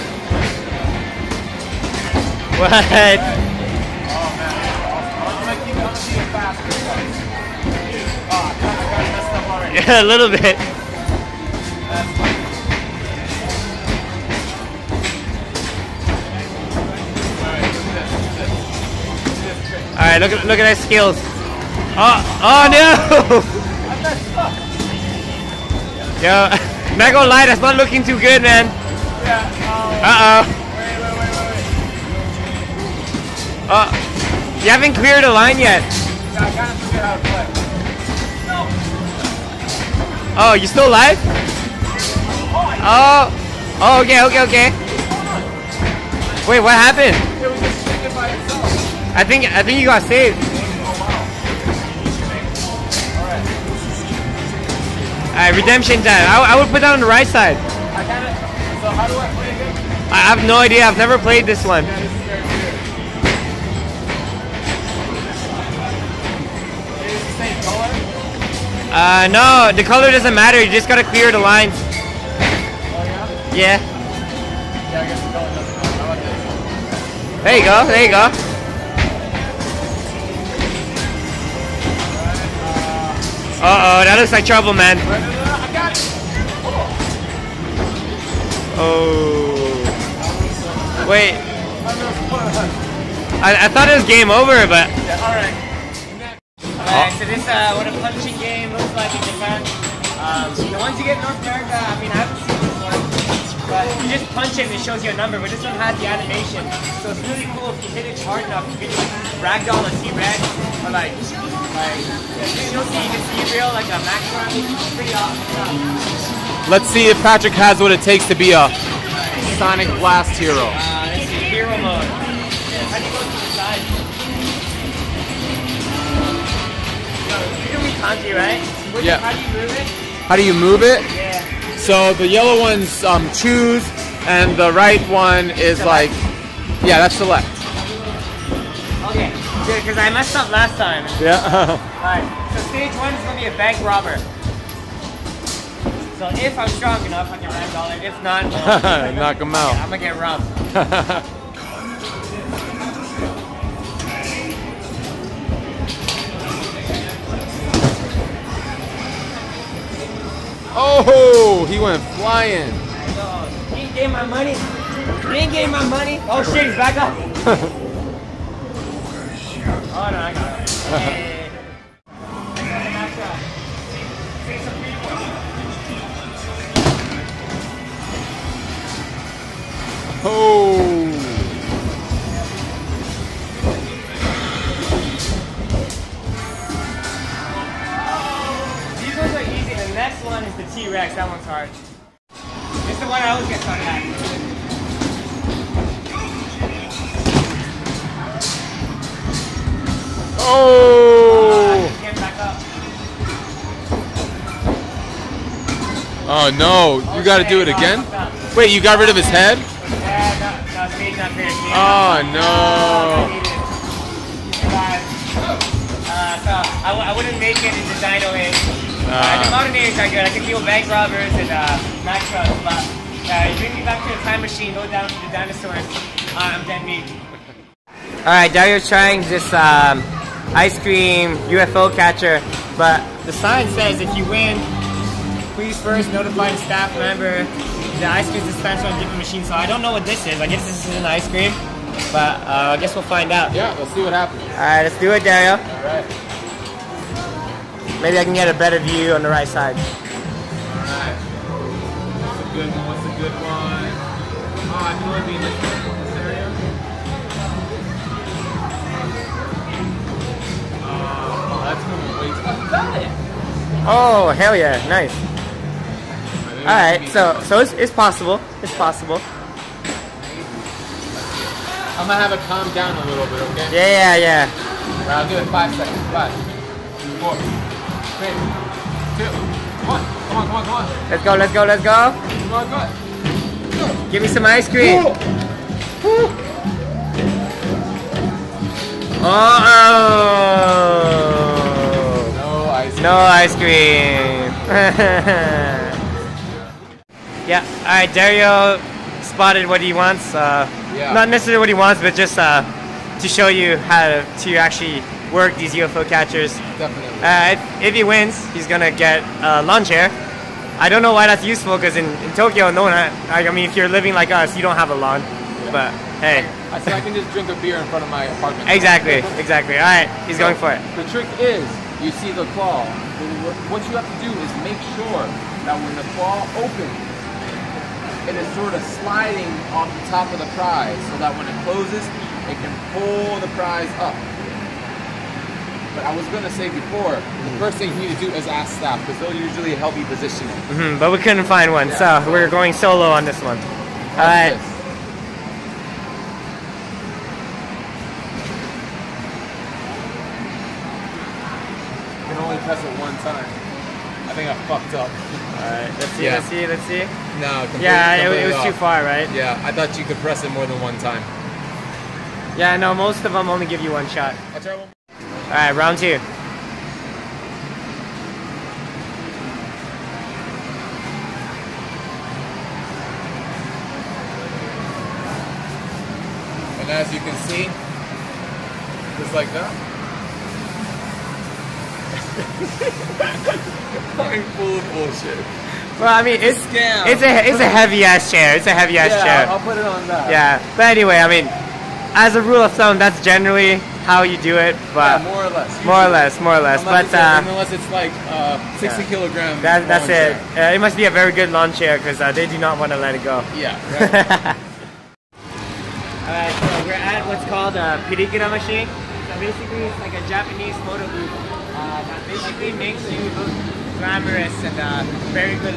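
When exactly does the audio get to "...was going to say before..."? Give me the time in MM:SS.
05:36.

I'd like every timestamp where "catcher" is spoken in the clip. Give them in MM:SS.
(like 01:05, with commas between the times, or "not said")
03:51, 05:06.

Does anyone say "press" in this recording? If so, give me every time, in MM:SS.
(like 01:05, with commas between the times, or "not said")
05:52, 06:00.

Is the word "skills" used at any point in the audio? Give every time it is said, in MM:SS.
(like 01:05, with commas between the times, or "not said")
00:20.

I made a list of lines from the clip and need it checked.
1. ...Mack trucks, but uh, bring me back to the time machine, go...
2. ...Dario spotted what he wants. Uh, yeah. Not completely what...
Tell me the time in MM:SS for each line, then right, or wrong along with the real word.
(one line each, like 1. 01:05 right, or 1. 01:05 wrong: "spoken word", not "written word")
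1. 03:42 right
2. 04:58 wrong: "necessarily", not "completely".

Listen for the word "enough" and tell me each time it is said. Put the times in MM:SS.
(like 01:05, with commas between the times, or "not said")
01:48, 02:27.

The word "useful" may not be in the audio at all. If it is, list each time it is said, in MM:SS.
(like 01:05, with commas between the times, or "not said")
05:11.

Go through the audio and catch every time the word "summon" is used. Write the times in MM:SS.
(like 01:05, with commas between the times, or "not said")
not said.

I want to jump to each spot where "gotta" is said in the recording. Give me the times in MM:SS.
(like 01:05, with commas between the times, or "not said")
01:10, 03:27.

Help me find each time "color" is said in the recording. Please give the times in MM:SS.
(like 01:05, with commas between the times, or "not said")
01:09.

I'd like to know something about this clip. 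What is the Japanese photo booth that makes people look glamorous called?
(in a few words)
pirikura.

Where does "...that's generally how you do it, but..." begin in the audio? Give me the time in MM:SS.
06:32.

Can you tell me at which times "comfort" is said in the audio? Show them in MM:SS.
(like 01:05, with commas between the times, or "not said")
not said.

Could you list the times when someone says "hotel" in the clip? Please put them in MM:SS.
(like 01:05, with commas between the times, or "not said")
not said.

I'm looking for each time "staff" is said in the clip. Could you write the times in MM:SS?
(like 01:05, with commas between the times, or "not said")
03:56, 05:38.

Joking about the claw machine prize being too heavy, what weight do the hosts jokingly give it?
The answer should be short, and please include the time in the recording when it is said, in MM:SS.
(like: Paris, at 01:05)
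60 kilograms, at 06:38.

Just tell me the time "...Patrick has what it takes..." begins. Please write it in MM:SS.
01:57.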